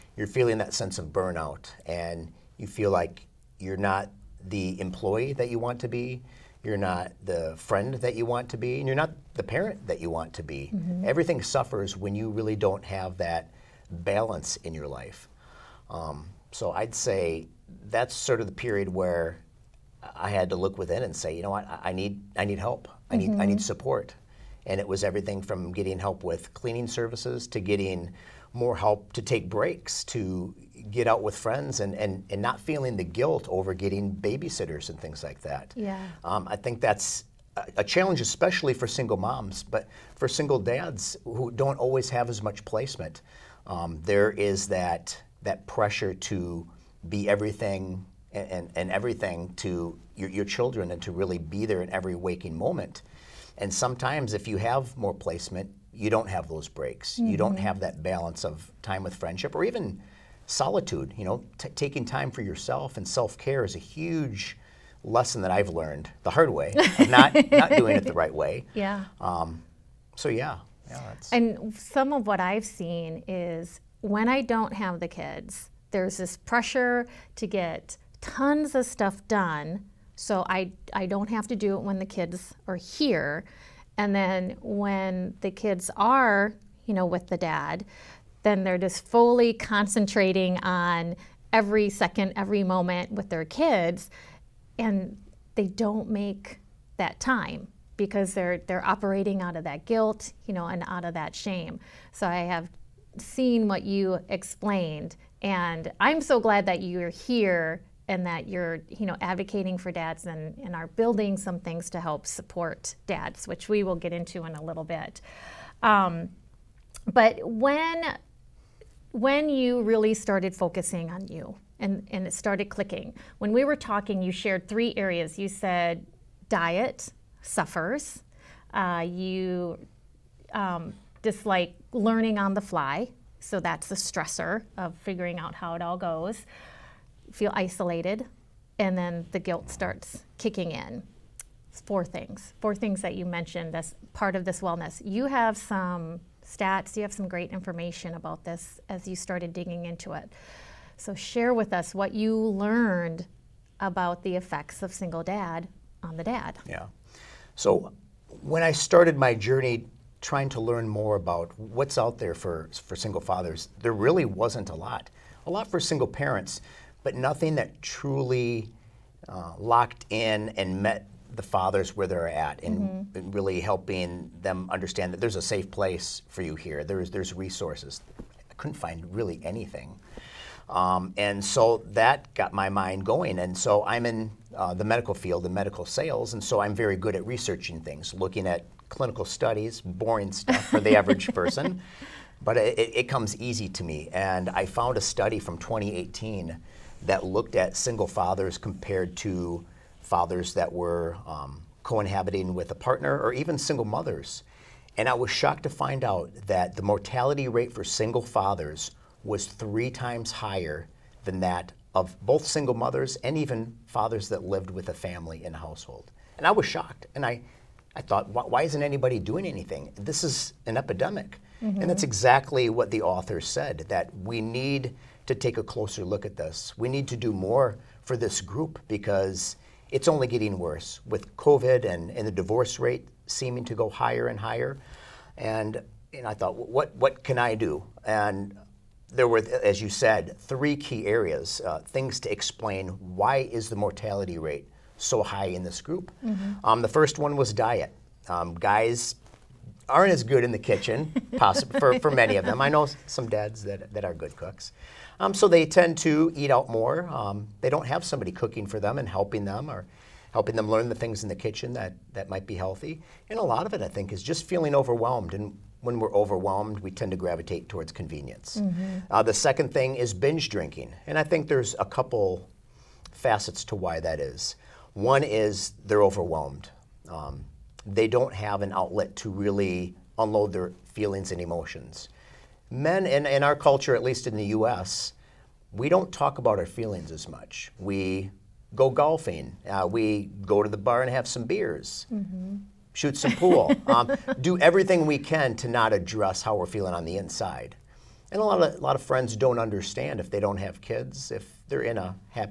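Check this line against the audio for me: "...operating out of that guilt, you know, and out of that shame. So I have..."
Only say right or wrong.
right.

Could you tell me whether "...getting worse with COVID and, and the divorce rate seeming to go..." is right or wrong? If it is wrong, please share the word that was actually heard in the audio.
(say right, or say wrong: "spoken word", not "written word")
right.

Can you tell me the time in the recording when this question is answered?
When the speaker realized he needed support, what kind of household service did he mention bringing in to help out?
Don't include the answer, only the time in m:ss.
0:26.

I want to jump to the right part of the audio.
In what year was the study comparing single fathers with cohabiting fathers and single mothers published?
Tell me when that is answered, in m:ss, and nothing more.
3:15.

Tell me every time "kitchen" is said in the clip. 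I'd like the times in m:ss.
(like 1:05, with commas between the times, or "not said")
4:10, 4:21.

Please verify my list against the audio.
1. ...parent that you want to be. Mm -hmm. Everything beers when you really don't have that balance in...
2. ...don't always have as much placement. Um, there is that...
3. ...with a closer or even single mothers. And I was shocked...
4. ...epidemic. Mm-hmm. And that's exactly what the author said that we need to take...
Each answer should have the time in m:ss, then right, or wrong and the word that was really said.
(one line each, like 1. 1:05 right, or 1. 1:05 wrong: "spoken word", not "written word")
1. 0:09 wrong: "suffers", not "beers"
2. 0:41 right
3. 3:22 wrong: "partner", not "closer"
4. 3:40 right.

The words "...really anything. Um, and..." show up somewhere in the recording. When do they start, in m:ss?
2:59.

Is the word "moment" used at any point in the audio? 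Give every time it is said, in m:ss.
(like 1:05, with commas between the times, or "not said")
0:52, 1:32.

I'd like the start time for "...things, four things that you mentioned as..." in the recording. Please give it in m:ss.
2:22.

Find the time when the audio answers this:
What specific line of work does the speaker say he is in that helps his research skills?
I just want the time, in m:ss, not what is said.
3:05.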